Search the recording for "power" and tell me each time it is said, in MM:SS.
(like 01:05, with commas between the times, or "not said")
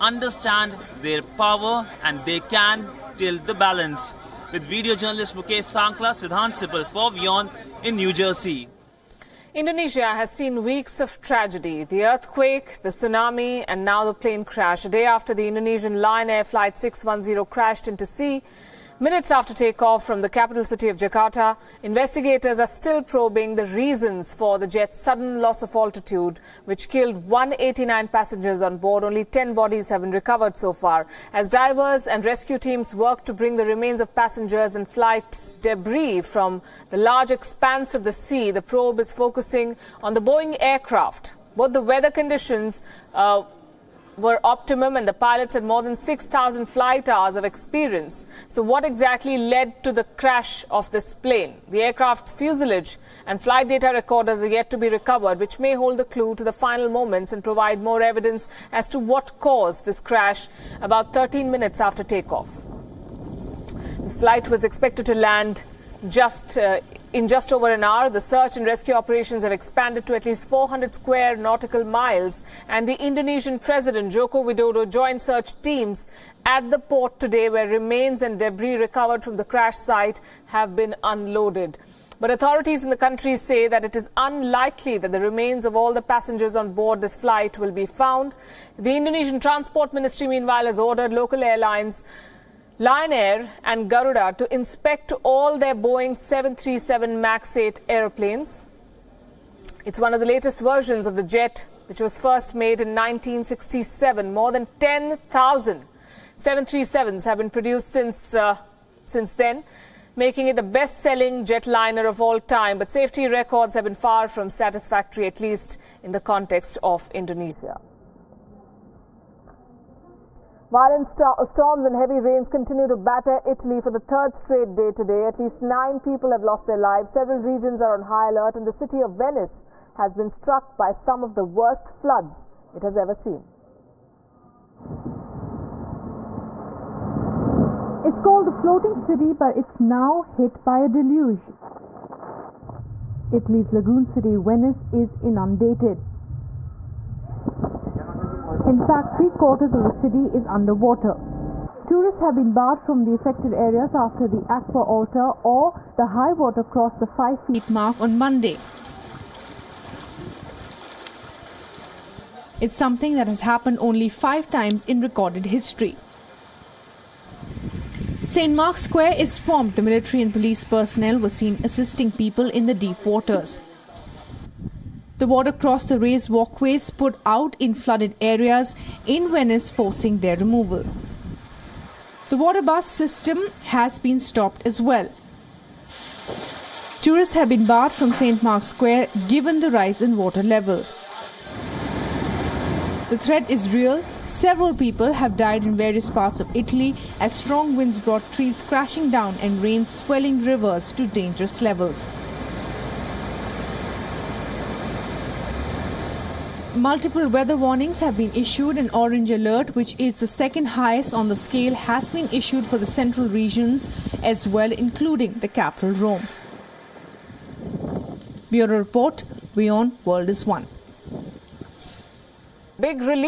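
00:01.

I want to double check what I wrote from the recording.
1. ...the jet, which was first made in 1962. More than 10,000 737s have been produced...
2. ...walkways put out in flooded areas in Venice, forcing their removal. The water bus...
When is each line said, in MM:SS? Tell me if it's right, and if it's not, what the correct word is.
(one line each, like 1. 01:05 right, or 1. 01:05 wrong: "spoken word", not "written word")
1. 01:41 wrong: "1967", not "1962"
2. 02:56 right.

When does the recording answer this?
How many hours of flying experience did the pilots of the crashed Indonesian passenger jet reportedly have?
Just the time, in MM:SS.
00:45.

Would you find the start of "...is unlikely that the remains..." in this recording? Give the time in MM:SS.
01:23.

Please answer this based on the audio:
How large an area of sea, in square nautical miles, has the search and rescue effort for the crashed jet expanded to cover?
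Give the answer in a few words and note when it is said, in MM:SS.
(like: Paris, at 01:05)
400, at 01:10.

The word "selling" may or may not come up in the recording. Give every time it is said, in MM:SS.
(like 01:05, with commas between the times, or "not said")
01:50.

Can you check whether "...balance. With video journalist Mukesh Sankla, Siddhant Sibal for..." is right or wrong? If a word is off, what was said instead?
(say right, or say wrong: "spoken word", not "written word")
right.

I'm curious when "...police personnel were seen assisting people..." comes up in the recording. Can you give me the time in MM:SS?
02:50.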